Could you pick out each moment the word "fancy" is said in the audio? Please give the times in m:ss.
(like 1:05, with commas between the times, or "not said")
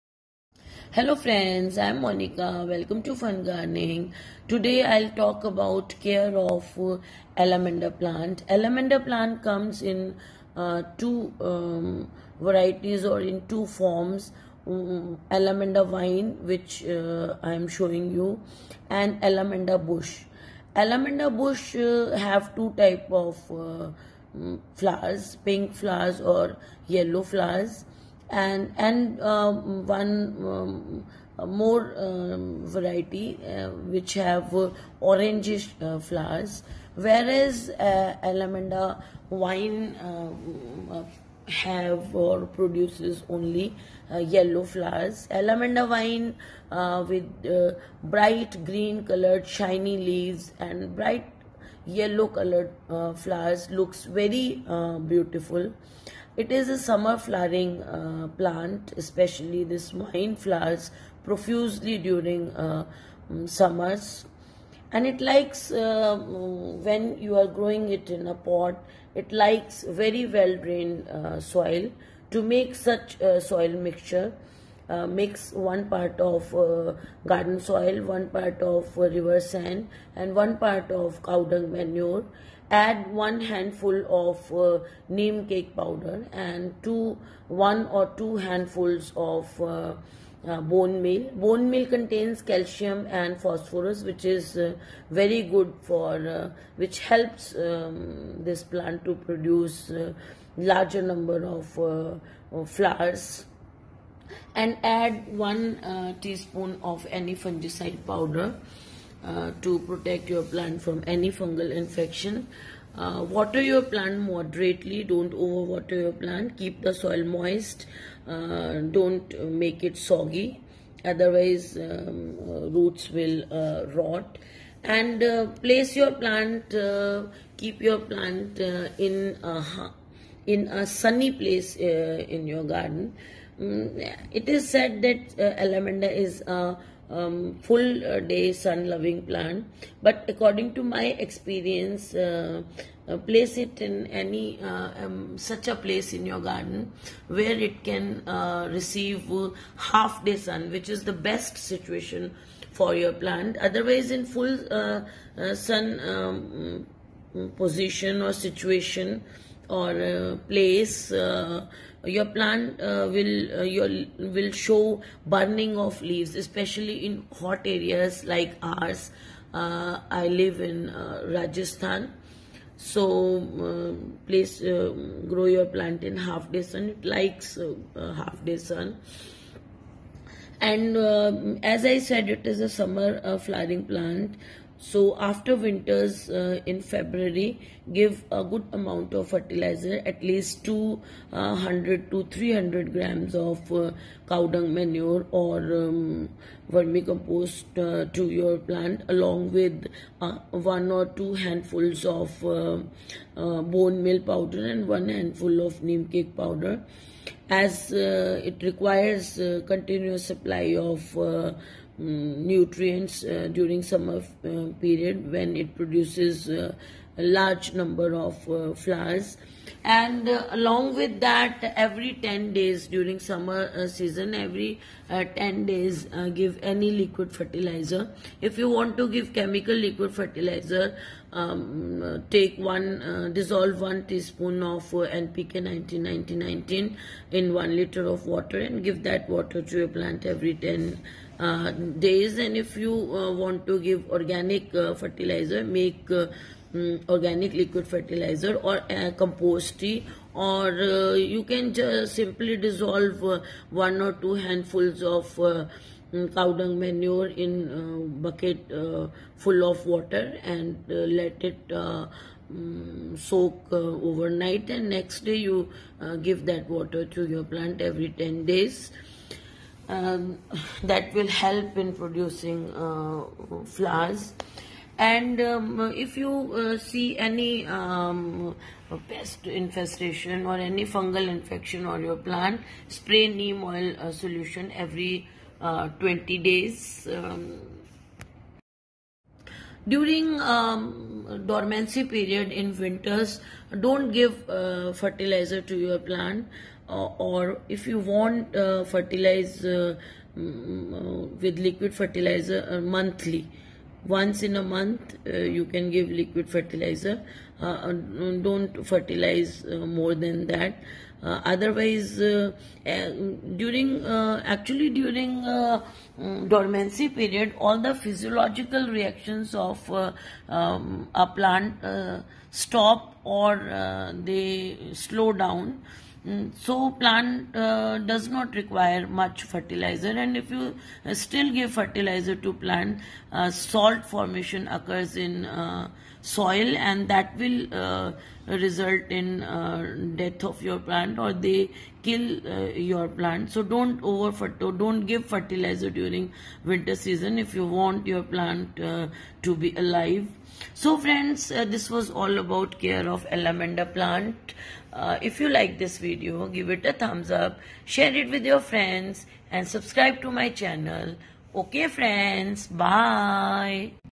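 not said.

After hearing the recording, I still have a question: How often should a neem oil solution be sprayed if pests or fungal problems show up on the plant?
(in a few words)
every 20 days.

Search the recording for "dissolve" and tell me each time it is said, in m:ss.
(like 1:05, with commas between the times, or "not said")
3:53, 4:12.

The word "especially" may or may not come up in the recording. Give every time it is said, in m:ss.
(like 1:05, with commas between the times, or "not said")
0:58, 2:46.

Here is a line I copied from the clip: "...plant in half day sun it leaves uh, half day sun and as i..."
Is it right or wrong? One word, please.
wrong.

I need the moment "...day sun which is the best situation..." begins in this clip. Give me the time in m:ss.
2:30.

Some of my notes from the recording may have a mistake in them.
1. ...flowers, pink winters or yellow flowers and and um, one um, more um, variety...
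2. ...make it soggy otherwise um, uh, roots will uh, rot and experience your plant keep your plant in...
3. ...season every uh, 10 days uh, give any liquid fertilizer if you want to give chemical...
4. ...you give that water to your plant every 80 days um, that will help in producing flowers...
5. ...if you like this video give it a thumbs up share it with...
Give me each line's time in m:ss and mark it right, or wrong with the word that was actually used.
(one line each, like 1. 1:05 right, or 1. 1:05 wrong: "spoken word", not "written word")
1. 0:24 wrong: "flowers", not "winters"
2. 1:59 wrong: "place", not "experience"
3. 3:43 right
4. 4:25 wrong: "10", not "80"
5. 5:55 right.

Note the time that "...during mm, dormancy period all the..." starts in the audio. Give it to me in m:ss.
5:14.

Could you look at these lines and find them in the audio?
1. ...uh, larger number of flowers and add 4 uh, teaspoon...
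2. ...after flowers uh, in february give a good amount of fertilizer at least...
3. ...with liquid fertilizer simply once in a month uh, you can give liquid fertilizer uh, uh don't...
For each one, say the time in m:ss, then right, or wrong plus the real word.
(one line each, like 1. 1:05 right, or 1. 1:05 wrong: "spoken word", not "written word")
1. 1:39 wrong: "1", not "4"
2. 3:05 wrong: "winters", not "flowers"
3. 5:01 wrong: "monthly", not "simply".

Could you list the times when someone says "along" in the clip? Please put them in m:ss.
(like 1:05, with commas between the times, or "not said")
3:19, 3:40.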